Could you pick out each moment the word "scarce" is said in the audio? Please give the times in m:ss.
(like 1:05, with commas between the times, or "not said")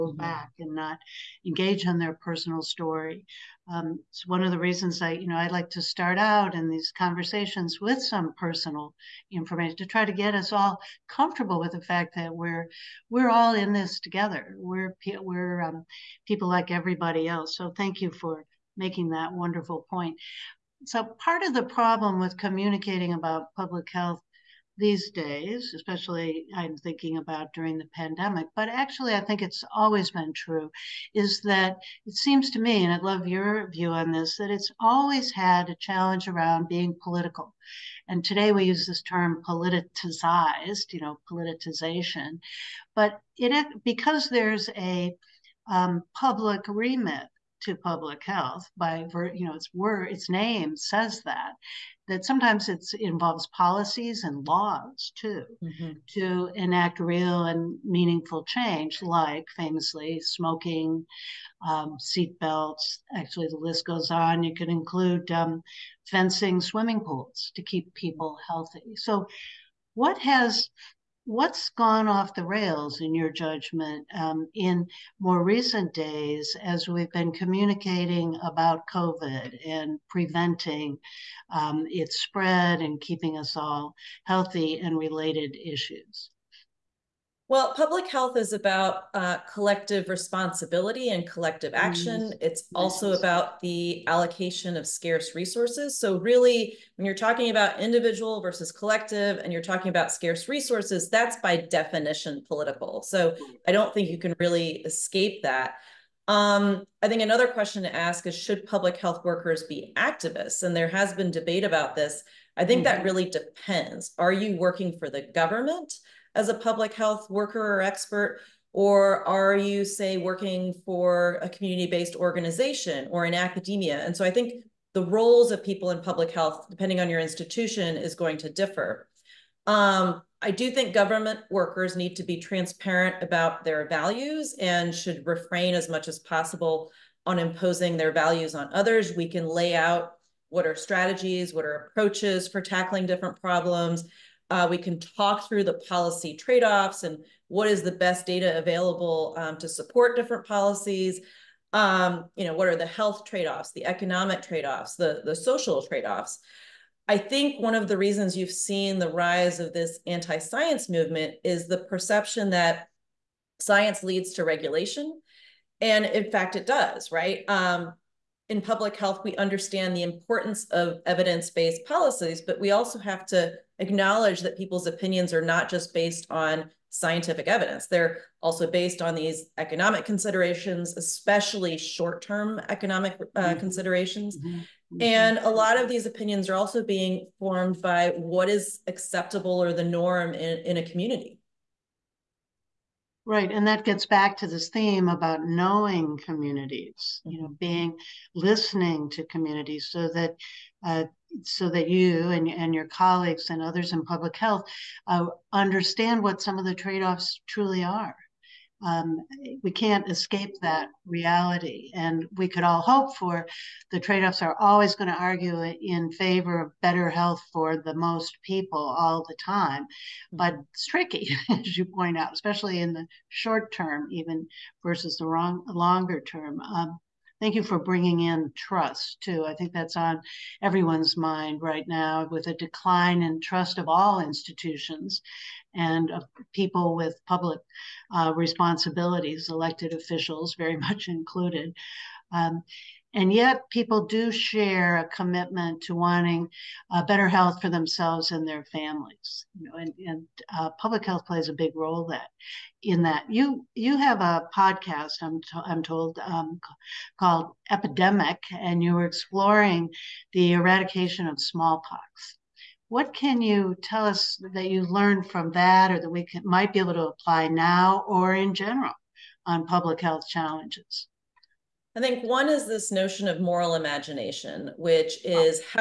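1:34, 1:40.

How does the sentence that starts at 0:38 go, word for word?
And today we use this term politicized, you know, politicization.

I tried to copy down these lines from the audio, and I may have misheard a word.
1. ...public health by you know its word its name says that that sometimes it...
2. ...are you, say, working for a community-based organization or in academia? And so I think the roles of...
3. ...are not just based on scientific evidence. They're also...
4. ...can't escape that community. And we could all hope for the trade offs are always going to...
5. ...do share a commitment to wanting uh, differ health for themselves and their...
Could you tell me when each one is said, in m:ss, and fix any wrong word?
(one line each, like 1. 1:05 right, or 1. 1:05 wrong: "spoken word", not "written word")
1. 0:47 right
2. 1:59 right
3. 2:55 right
4. 3:29 wrong: "reality", not "community"
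5. 4:04 wrong: "better", not "differ".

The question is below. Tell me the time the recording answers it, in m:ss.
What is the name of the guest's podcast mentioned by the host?
4:17.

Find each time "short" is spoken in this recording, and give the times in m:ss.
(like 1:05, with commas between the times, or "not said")
3:01, 3:43.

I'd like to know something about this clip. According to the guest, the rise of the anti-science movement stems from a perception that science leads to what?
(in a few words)
regulation.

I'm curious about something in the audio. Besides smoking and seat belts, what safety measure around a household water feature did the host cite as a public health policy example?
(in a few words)
fencing swimming pools.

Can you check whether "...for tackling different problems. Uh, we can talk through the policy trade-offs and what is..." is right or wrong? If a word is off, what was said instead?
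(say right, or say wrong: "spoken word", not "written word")
right.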